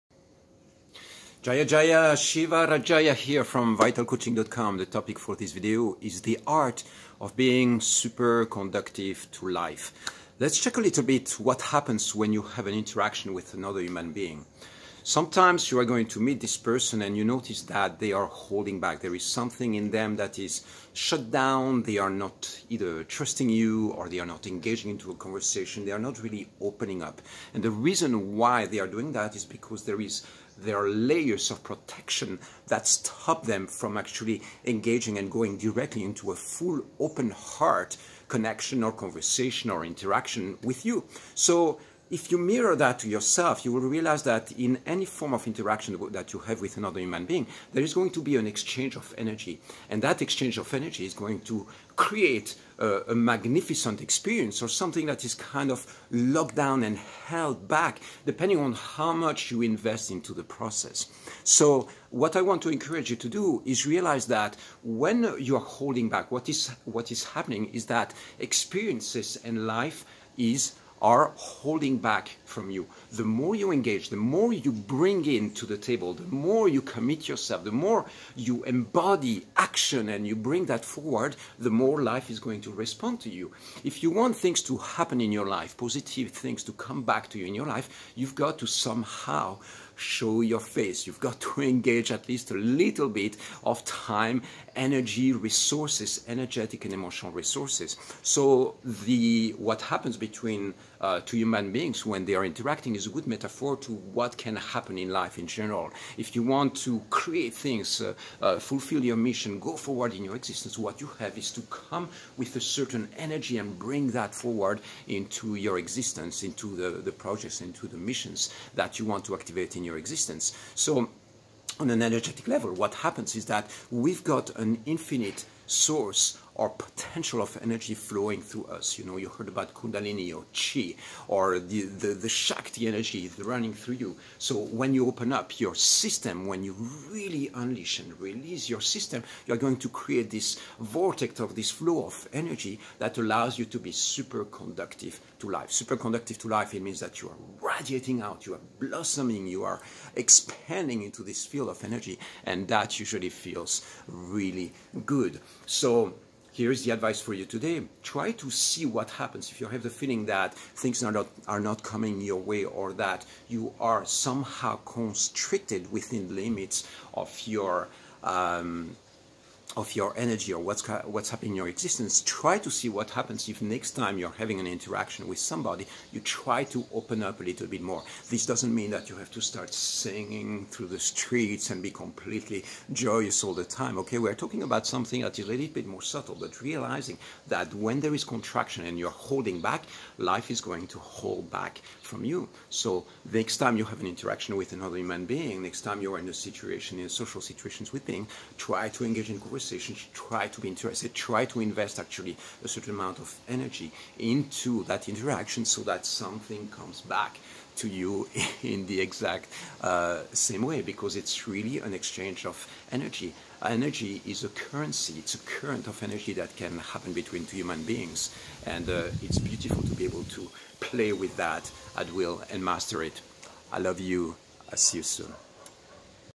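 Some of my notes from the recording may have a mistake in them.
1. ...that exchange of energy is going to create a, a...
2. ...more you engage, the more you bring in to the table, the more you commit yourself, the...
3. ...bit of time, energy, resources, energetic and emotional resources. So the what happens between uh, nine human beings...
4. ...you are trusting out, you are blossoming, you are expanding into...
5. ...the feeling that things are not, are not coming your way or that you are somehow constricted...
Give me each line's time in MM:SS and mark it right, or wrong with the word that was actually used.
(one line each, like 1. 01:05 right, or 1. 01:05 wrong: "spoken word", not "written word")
1. 00:50 right
2. 01:13 right
3. 01:33 wrong: "two", not "nine"
4. 02:27 wrong: "radiating", not "trusting"
5. 02:39 right.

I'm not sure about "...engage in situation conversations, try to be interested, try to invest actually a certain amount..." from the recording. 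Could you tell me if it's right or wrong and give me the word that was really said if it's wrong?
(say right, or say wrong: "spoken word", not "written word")
wrong: "conversation", not "situation".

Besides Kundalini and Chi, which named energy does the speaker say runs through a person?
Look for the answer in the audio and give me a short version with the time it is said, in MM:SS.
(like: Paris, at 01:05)
Shakti, at 02:12.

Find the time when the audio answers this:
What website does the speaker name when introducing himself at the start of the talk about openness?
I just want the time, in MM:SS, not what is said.
00:03.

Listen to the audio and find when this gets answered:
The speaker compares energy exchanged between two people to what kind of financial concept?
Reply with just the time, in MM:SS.
03:34.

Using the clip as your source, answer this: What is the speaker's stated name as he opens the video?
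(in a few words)
Jaya Jaya Shiva Rajaya.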